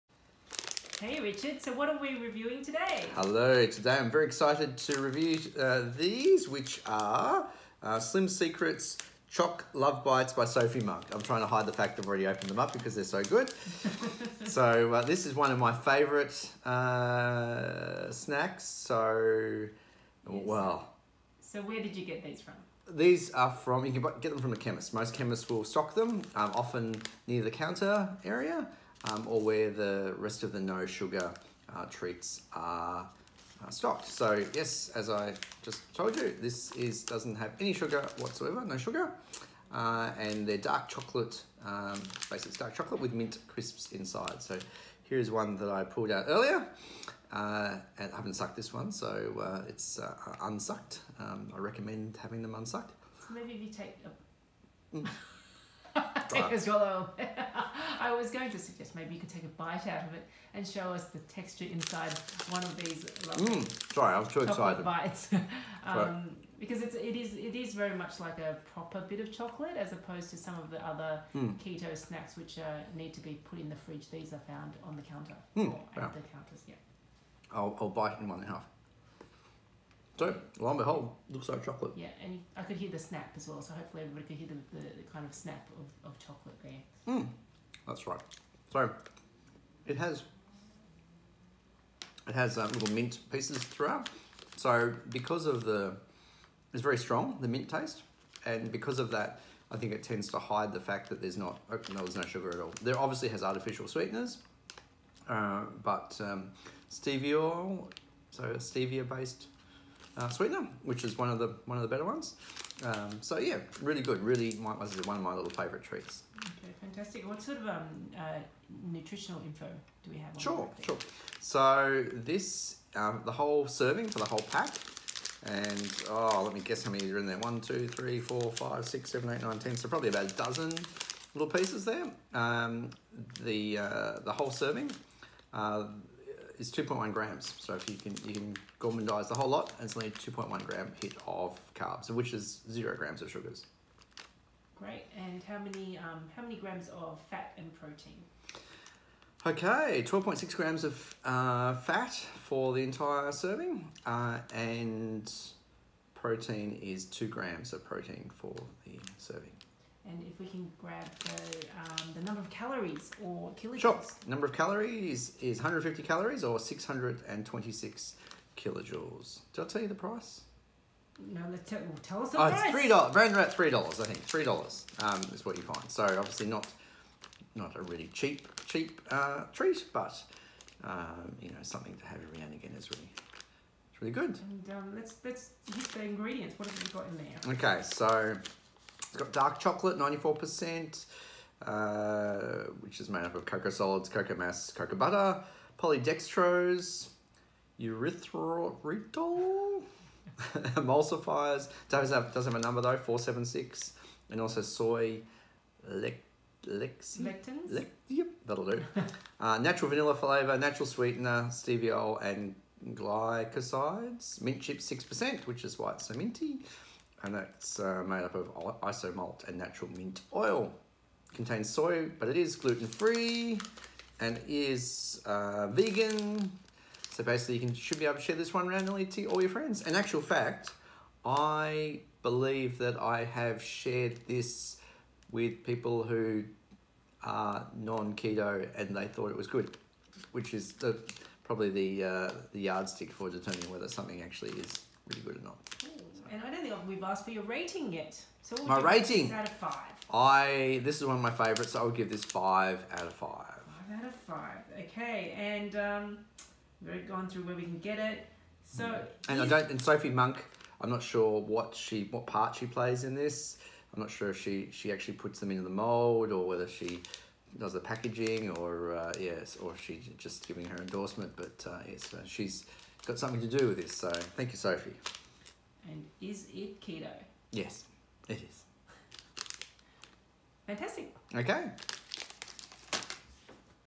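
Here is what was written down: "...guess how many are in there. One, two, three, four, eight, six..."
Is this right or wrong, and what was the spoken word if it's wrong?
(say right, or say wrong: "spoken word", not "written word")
wrong: "five", not "eight".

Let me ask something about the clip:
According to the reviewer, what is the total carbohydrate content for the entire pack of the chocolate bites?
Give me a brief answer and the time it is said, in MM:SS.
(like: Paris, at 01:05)
2.1 grams, at 02:16.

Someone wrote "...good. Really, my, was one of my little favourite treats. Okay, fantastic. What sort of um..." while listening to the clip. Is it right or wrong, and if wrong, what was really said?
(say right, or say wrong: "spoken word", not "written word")
right.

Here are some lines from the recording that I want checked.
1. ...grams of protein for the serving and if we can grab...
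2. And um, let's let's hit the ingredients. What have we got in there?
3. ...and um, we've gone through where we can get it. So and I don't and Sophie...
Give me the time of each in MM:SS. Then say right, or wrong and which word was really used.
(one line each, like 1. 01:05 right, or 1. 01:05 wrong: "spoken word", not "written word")
1. 02:37 right
2. 03:04 right
3. 04:15 right.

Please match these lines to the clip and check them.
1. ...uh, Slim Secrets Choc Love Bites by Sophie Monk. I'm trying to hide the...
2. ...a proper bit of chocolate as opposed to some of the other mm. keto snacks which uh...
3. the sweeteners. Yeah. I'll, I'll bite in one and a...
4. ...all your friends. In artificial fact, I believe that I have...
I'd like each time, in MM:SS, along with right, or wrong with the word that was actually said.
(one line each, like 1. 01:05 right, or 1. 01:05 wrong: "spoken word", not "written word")
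1. 00:07 right
2. 01:08 right
3. 01:16 wrong: "counters", not "sweeteners"
4. 03:49 wrong: "actual", not "artificial".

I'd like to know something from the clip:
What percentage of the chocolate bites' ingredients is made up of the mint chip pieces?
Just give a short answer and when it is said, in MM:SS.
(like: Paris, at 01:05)
6%, at 03:34.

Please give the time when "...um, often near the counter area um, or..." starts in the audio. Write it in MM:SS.
00:26.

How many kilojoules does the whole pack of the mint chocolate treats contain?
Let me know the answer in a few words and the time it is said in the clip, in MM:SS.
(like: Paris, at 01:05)
626, at 02:46.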